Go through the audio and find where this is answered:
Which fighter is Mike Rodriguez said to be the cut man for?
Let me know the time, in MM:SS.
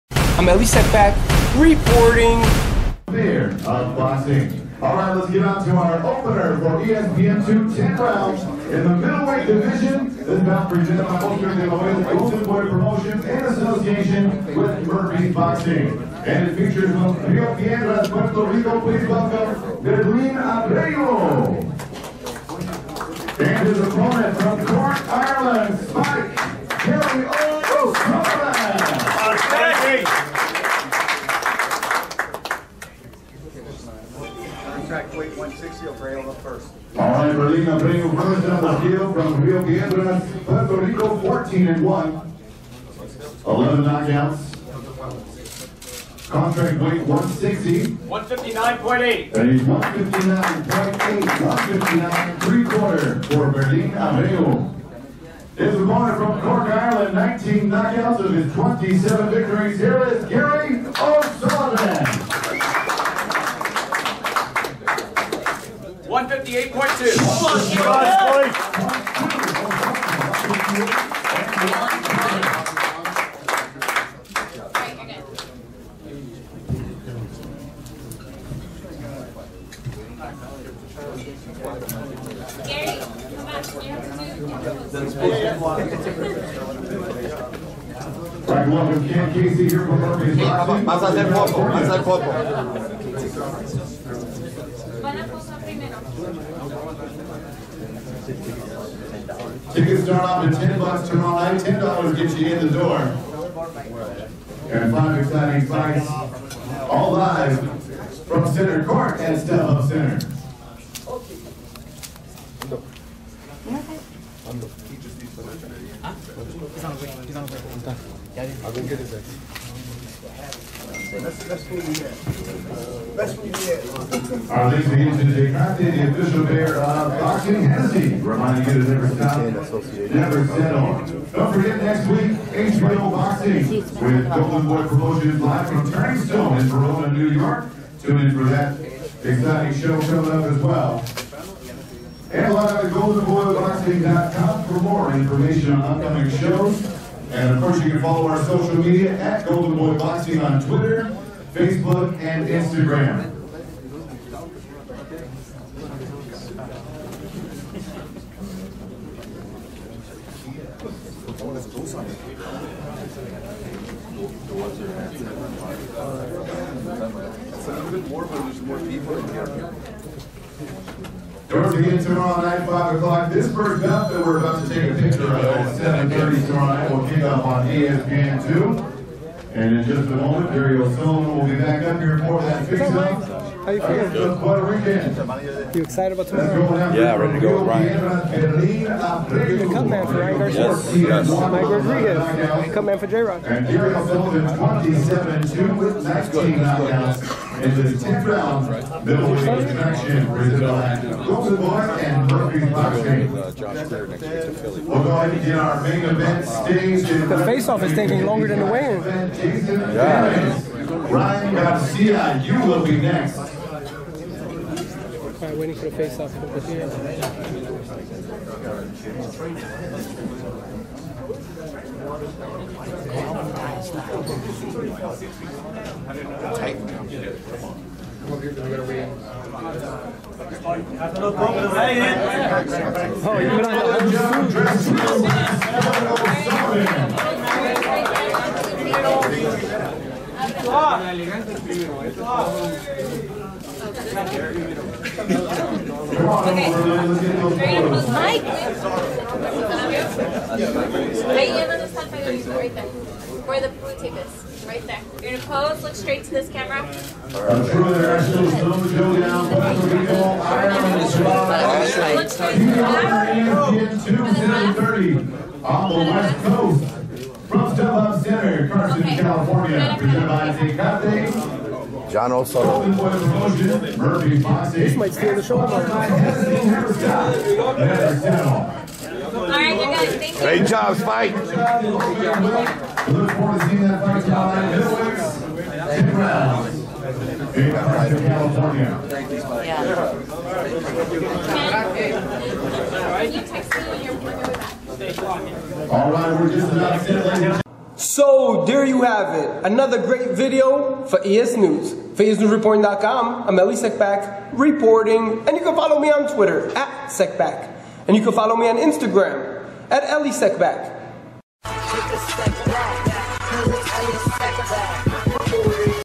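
03:13.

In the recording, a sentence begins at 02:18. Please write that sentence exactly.
Tune in for that exciting show coming up as well.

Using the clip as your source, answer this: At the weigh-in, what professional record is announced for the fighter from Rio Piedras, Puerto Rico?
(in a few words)
14 and 1.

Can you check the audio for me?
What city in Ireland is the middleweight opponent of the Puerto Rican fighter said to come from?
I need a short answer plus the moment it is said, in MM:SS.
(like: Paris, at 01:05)
Cork, at 00:56.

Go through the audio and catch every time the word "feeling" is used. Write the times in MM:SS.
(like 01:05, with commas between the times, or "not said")
03:04.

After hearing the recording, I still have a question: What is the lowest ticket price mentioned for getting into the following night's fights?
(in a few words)
$10.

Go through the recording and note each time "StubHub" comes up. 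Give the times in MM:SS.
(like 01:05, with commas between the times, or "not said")
01:49, 04:27.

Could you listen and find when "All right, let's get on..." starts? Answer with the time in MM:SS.
00:04.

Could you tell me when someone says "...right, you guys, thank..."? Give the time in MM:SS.
04:39.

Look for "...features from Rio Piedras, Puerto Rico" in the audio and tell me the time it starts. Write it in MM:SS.
00:16.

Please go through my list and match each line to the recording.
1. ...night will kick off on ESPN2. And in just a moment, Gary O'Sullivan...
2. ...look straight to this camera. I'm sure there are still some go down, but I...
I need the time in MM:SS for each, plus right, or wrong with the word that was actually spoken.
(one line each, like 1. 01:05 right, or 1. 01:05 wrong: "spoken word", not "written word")
1. 02:56 right
2. 04:15 right.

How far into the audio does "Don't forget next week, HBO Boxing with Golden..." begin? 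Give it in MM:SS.
02:11.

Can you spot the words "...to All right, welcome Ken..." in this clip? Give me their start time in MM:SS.
01:26.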